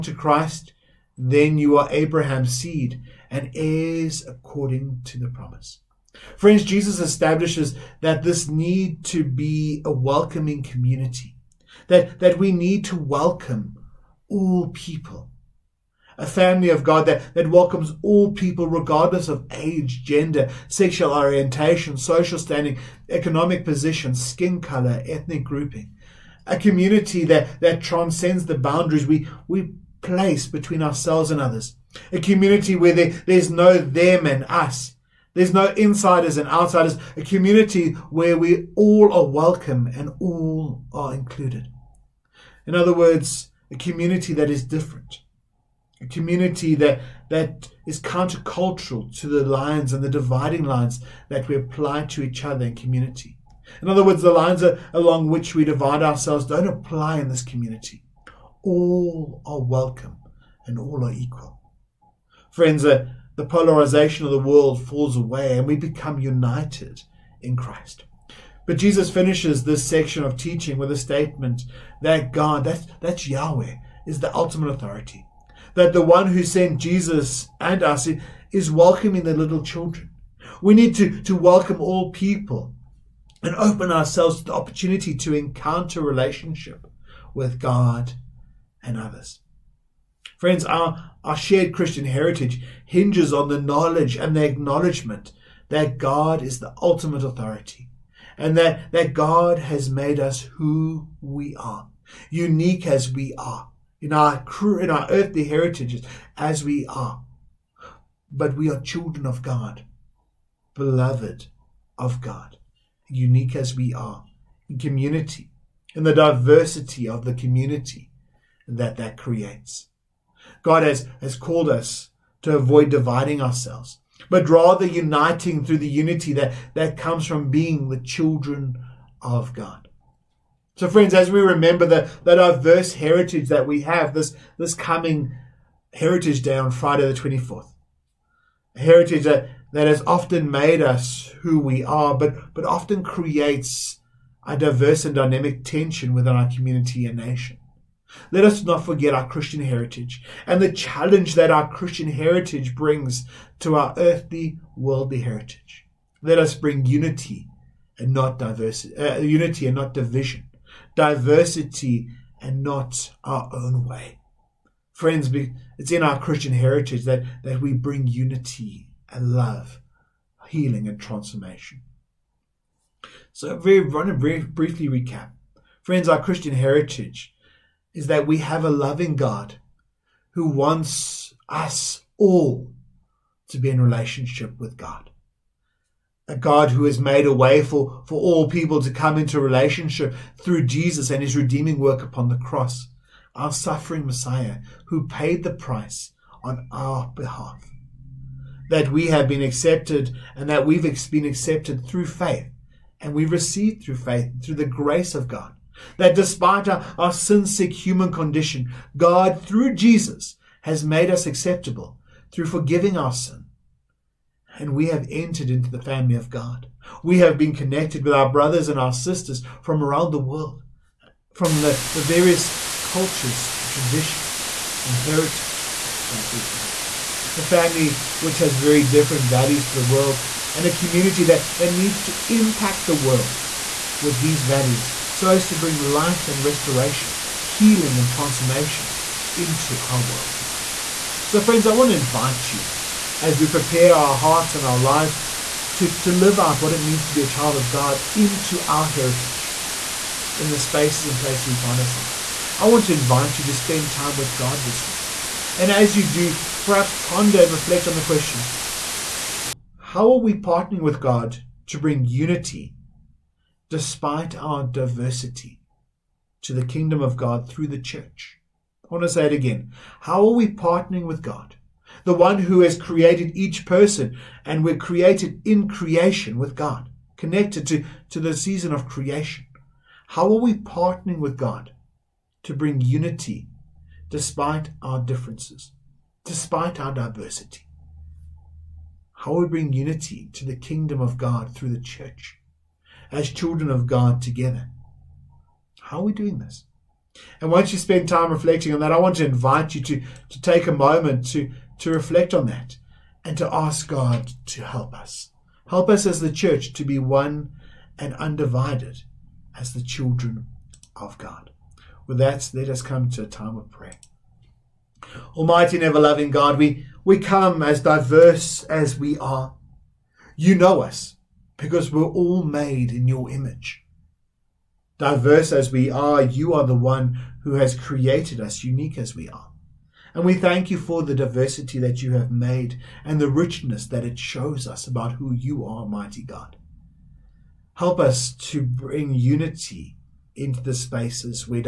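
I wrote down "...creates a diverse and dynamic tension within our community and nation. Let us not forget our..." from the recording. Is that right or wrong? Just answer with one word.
right.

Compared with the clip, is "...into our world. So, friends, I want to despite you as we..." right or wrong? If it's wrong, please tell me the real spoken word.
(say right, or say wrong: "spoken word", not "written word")
wrong: "invite", not "despite".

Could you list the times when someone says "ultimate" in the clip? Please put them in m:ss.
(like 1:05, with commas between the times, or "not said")
1:14, 1:36.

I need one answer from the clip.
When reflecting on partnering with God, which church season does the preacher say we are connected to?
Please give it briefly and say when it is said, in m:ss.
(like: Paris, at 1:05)
Season of Creation, at 4:38.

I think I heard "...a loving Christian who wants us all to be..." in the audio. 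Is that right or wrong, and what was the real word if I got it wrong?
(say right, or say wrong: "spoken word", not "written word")
wrong: "God", not "Christian".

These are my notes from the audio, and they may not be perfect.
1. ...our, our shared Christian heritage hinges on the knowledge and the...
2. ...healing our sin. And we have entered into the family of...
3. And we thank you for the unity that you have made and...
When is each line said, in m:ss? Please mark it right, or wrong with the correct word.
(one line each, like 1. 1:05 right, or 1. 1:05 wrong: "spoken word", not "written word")
1. 1:30 right
2. 3:32 wrong: "forgiving", not "healing"
3. 5:30 wrong: "diversity", not "unity".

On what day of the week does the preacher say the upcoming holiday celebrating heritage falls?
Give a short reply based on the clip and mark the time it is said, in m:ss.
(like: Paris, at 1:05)
Friday, at 2:16.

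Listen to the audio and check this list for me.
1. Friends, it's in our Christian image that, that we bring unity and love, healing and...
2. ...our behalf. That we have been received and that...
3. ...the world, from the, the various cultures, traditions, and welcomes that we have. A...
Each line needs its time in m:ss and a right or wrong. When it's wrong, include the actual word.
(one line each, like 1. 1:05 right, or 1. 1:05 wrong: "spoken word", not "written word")
1. 2:44 wrong: "heritage", not "image"
2. 3:16 wrong: "accepted", not "received"
3. 3:40 wrong: "heritages", not "welcomes".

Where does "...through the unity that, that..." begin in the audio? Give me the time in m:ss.
2:05.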